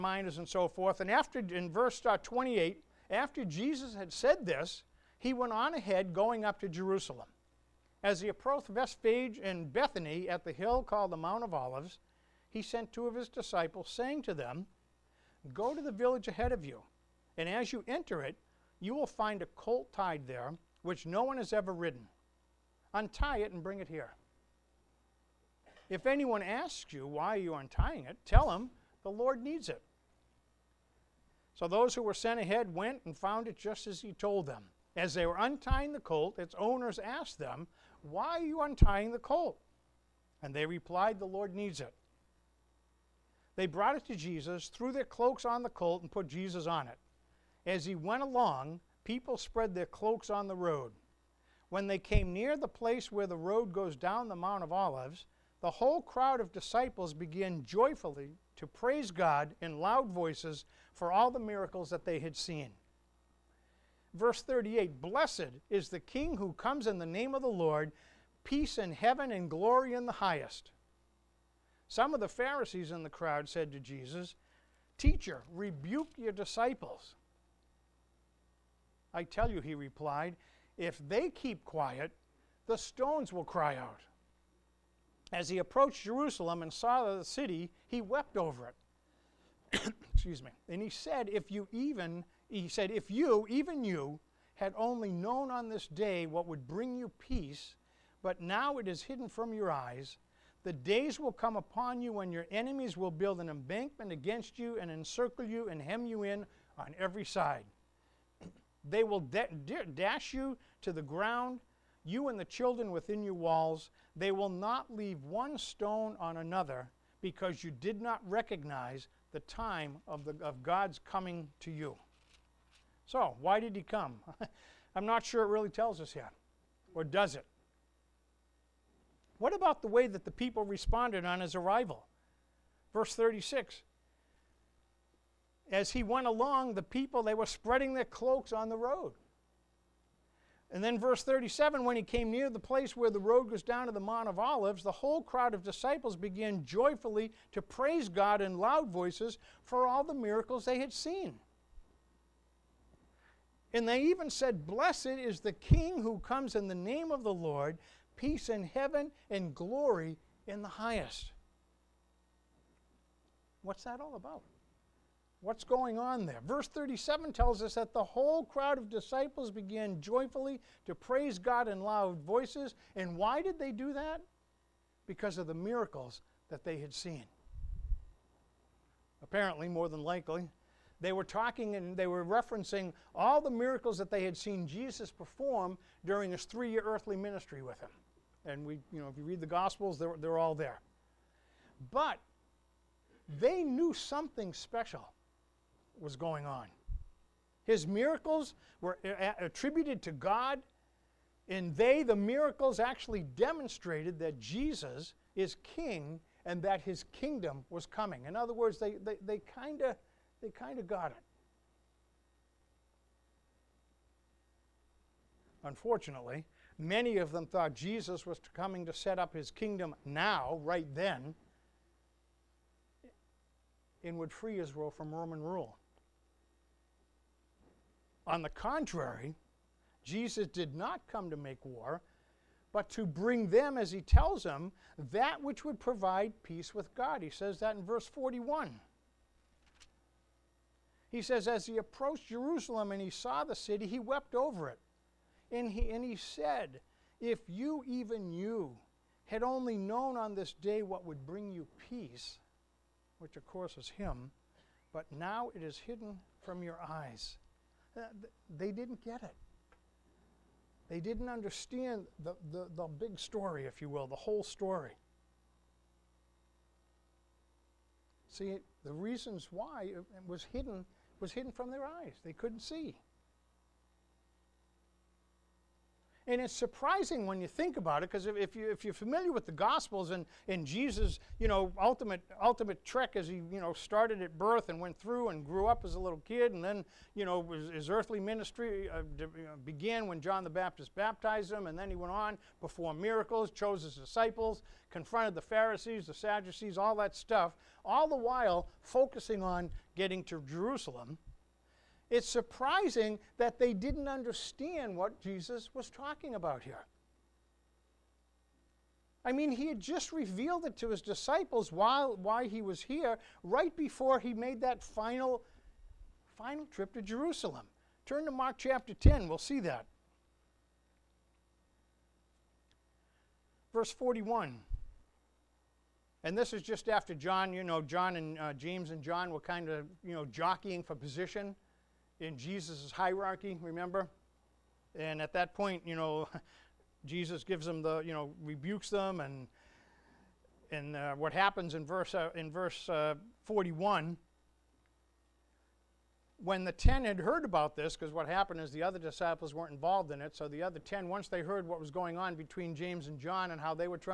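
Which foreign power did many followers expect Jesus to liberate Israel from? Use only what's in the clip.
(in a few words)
Roman rule.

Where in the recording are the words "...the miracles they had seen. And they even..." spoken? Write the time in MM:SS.
02:30.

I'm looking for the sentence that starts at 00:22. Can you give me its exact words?
Untie it and bring it here.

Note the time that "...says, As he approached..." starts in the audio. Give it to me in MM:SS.
04:01.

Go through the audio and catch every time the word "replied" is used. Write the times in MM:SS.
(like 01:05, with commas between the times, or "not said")
00:40, 01:19.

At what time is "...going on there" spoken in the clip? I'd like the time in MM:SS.
02:45.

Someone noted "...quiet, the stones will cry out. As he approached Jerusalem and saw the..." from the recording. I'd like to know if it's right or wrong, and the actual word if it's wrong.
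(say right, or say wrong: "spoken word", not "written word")
right.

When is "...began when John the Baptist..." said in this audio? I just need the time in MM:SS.
04:49.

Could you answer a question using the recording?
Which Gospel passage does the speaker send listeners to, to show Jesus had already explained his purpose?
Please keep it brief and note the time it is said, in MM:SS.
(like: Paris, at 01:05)
Mark chapter 10, at 05:18.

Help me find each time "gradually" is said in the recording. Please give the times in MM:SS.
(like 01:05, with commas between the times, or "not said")
not said.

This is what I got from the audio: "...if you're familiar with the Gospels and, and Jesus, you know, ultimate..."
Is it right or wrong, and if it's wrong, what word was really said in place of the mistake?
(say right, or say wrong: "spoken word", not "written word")
right.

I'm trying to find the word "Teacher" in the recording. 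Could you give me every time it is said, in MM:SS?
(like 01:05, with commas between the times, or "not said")
01:14.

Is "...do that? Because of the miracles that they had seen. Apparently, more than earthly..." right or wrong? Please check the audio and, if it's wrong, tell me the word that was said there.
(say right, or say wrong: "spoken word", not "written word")
wrong: "likely", not "earthly".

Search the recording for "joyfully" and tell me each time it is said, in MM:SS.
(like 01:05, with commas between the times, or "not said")
00:57, 02:26, 02:49.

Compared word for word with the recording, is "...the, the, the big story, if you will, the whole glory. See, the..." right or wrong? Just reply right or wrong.
wrong.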